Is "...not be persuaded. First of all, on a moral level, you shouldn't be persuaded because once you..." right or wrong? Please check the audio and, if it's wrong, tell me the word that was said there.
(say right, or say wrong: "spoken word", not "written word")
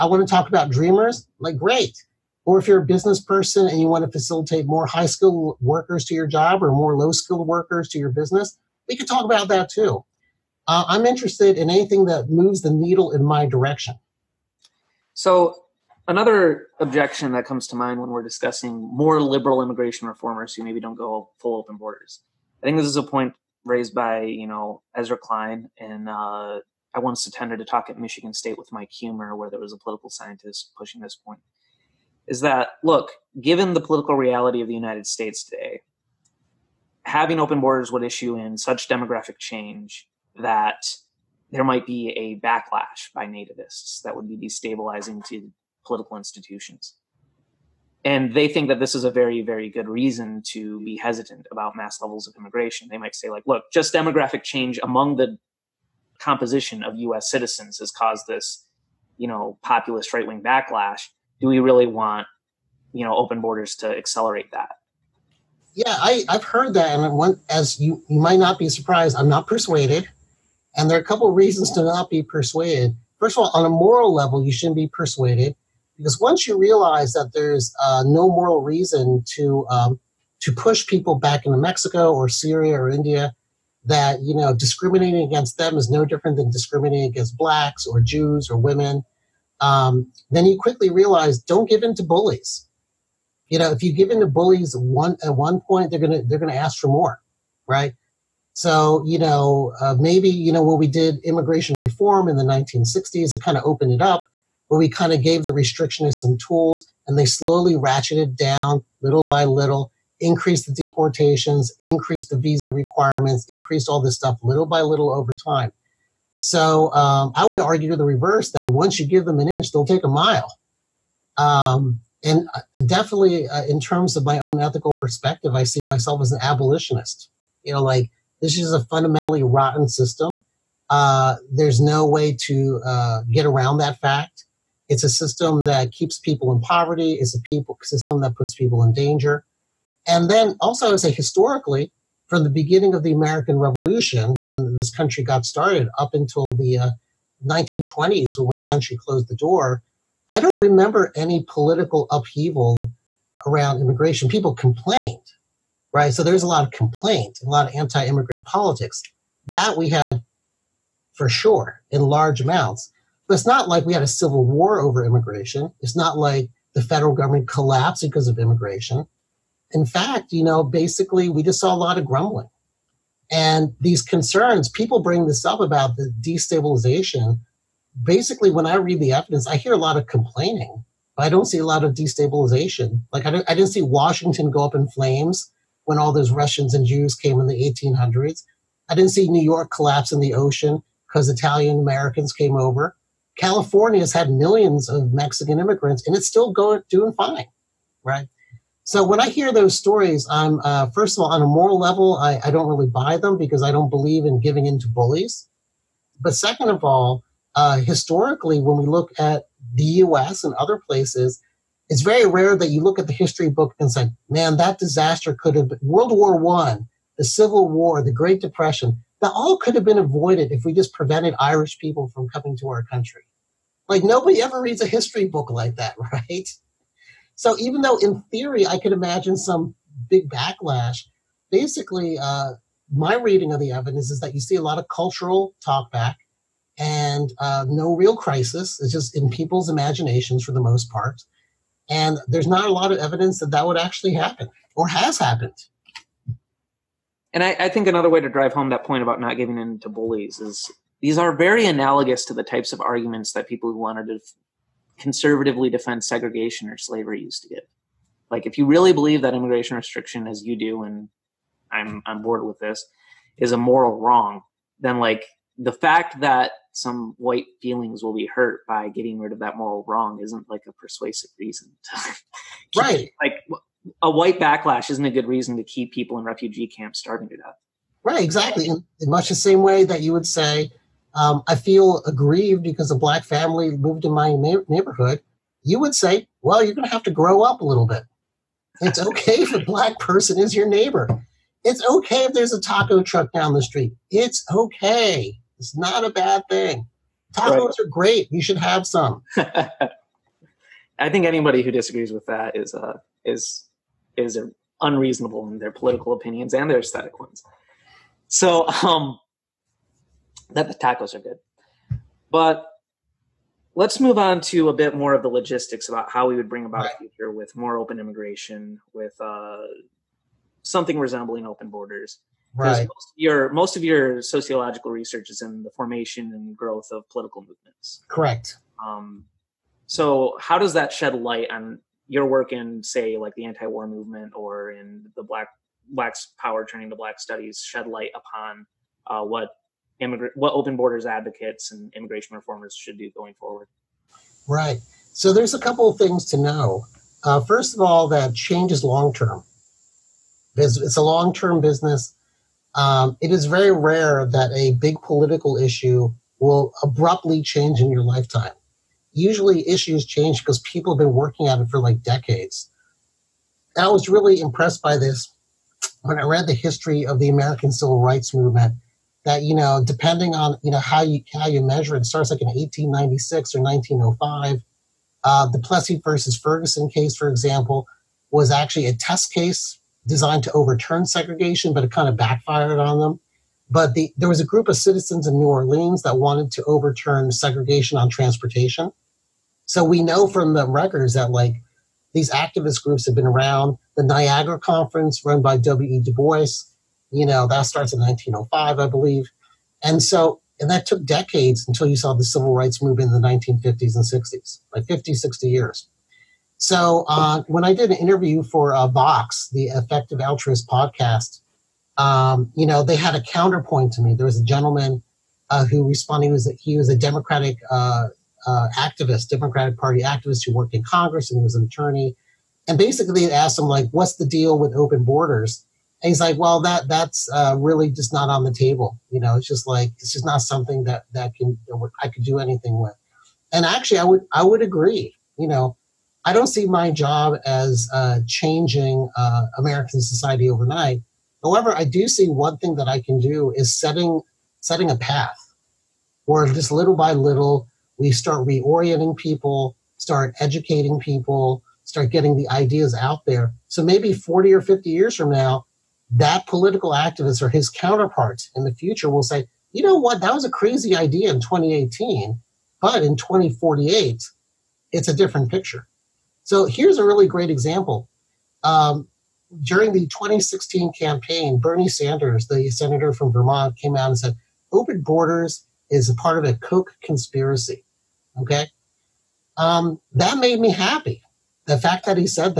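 right.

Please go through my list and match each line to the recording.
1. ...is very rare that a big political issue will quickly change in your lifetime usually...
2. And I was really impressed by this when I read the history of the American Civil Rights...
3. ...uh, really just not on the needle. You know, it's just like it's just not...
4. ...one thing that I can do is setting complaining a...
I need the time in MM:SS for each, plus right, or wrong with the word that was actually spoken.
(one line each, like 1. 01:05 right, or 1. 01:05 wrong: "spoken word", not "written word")
1. 05:53 wrong: "abruptly", not "quickly"
2. 06:03 right
3. 07:07 wrong: "table", not "needle"
4. 07:22 wrong: "setting", not "complaining".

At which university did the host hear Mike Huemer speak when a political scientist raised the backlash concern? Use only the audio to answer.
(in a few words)
Michigan State.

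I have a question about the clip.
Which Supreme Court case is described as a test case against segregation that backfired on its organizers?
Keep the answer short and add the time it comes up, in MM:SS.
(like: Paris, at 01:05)
Plessy versus Ferguson, at 06:15.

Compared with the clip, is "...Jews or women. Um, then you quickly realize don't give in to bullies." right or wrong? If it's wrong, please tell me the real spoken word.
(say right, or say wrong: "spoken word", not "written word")
right.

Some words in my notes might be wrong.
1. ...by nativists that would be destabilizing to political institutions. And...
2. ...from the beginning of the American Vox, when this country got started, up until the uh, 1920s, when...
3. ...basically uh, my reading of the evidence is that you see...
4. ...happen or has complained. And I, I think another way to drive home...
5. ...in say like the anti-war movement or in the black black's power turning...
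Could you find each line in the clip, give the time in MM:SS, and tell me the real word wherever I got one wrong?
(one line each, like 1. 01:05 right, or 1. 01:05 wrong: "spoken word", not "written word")
1. 00:43 right
2. 02:22 wrong: "Revolution", not "Vox"
3. 03:51 right
4. 04:04 wrong: "happened", not "complained"
5. 05:32 right.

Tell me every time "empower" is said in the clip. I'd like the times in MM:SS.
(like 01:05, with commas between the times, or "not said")
not said.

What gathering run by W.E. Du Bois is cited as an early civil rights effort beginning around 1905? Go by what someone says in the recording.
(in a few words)
The Niagara Conference.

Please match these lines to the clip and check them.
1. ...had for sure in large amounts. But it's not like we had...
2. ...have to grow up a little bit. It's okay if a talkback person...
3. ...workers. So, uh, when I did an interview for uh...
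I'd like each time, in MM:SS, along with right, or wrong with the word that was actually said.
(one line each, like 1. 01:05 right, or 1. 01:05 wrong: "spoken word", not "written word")
1. 02:39 right
2. 04:46 wrong: "black", not "talkback"
3. 06:45 wrong: "years", not "workers".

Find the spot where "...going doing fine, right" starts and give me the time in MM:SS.
03:16.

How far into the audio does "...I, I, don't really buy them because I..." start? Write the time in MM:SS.
03:22.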